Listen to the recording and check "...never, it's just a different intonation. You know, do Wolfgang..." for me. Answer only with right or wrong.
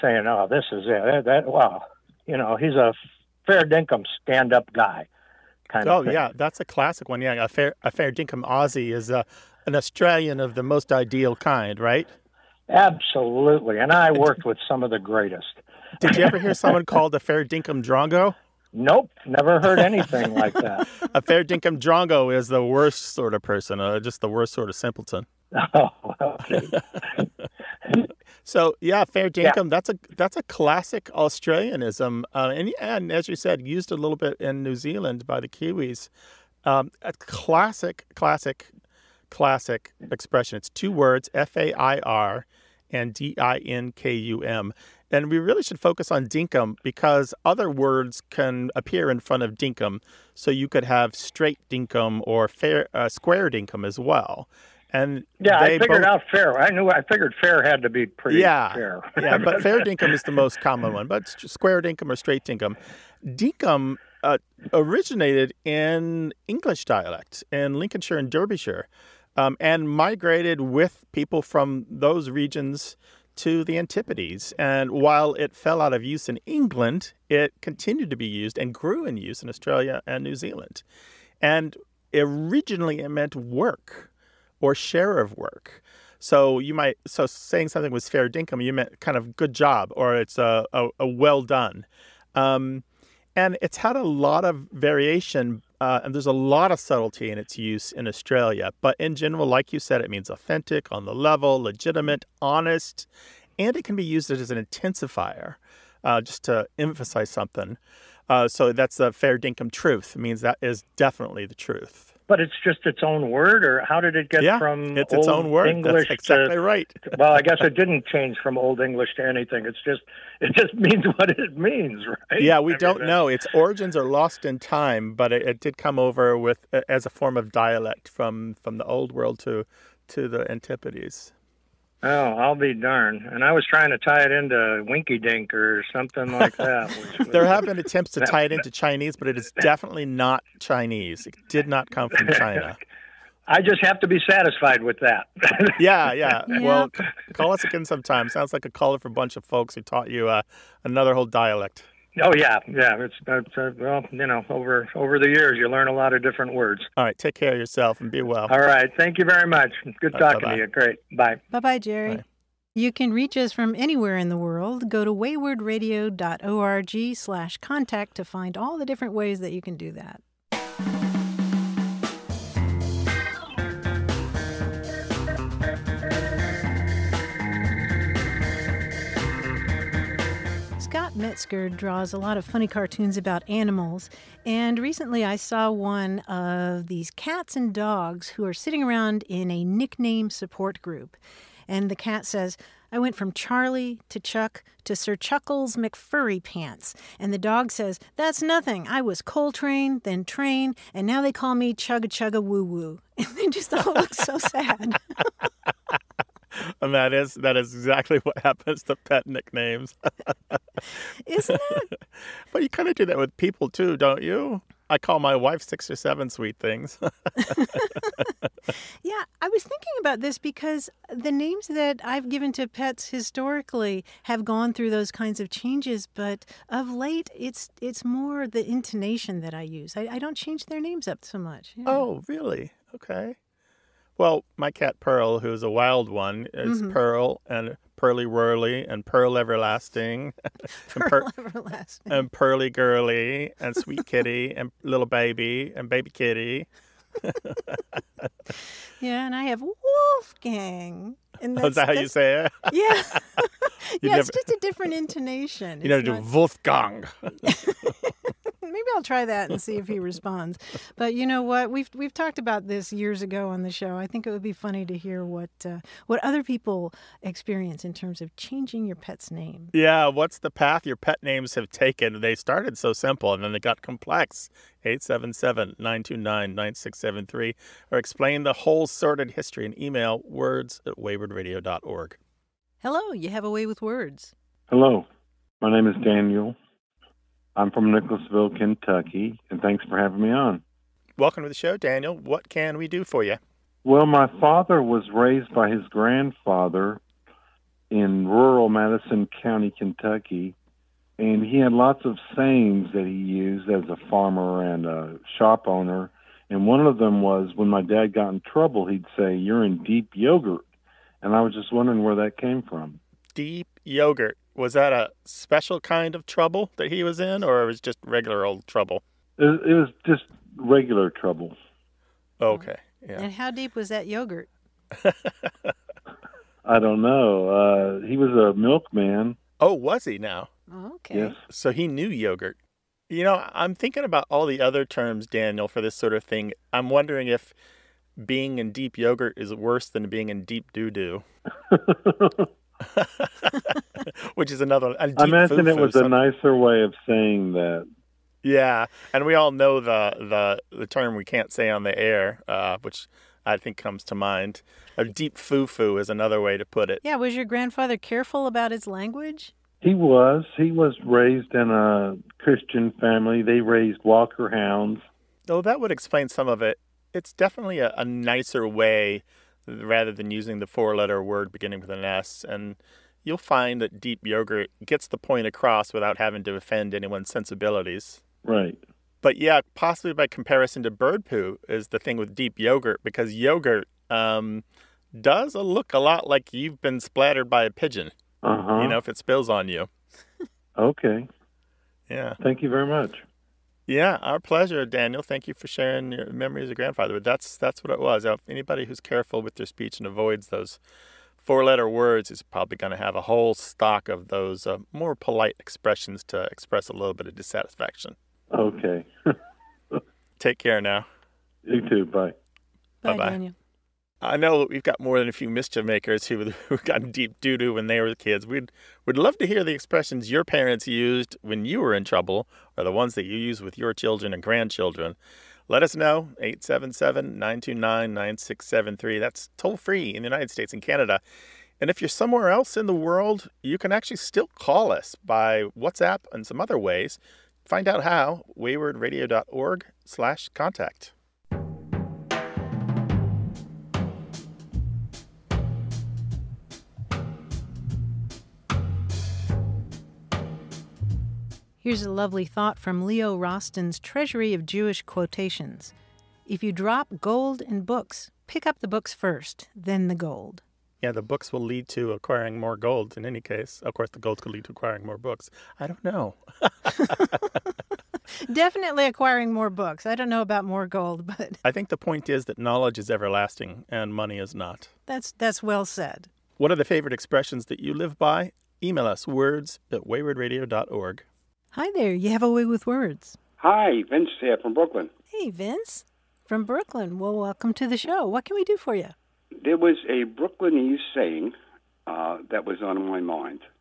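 right.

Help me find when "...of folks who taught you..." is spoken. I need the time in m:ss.
2:29.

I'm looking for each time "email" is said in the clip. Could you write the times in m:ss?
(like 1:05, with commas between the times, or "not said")
4:39, 7:58.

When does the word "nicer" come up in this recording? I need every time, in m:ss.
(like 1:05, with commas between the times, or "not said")
5:46, 6:08.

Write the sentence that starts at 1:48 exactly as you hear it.
Uh, so that's the fair dinkum truth.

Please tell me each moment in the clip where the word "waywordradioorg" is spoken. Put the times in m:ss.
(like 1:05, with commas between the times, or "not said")
2:45, 4:40, 7:18, 8:00.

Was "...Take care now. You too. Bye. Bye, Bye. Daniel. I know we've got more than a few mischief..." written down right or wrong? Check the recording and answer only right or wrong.
right.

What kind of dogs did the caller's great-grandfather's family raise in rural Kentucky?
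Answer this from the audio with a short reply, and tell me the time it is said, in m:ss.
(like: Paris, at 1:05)
Walker hounds, at 6:04.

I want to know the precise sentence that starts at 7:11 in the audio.
And if you're somewhere else in the world, you can actually still call us by WhatsApp and some other ways.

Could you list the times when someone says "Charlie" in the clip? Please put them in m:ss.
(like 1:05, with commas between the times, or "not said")
3:13.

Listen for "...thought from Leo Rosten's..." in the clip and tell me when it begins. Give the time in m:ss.
7:32.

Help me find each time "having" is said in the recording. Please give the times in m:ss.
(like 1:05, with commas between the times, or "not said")
4:49, 6:16.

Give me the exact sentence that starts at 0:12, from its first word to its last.
Absolutely, and I worked with some of the greatest.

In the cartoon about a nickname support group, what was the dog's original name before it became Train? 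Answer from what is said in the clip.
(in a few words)
Coltrane.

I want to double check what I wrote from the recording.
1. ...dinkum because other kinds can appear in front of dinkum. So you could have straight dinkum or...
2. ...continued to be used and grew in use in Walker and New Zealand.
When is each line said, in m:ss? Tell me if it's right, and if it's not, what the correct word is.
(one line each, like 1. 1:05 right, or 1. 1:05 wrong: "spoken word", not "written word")
1. 0:46 wrong: "words", not "kinds"
2. 1:17 wrong: "Australia", not "Walker".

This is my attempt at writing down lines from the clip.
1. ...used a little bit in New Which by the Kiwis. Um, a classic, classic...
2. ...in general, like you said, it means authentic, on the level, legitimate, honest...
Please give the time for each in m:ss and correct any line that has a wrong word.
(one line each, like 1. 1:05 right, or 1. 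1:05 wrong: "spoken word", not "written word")
1. 0:33 wrong: "Zealand", not "Which"
2. 1:38 right.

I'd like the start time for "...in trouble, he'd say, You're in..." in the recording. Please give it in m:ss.
5:08.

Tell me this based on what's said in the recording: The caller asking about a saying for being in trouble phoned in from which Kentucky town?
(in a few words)
Nicholasville.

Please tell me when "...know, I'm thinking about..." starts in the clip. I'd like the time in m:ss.
5:33.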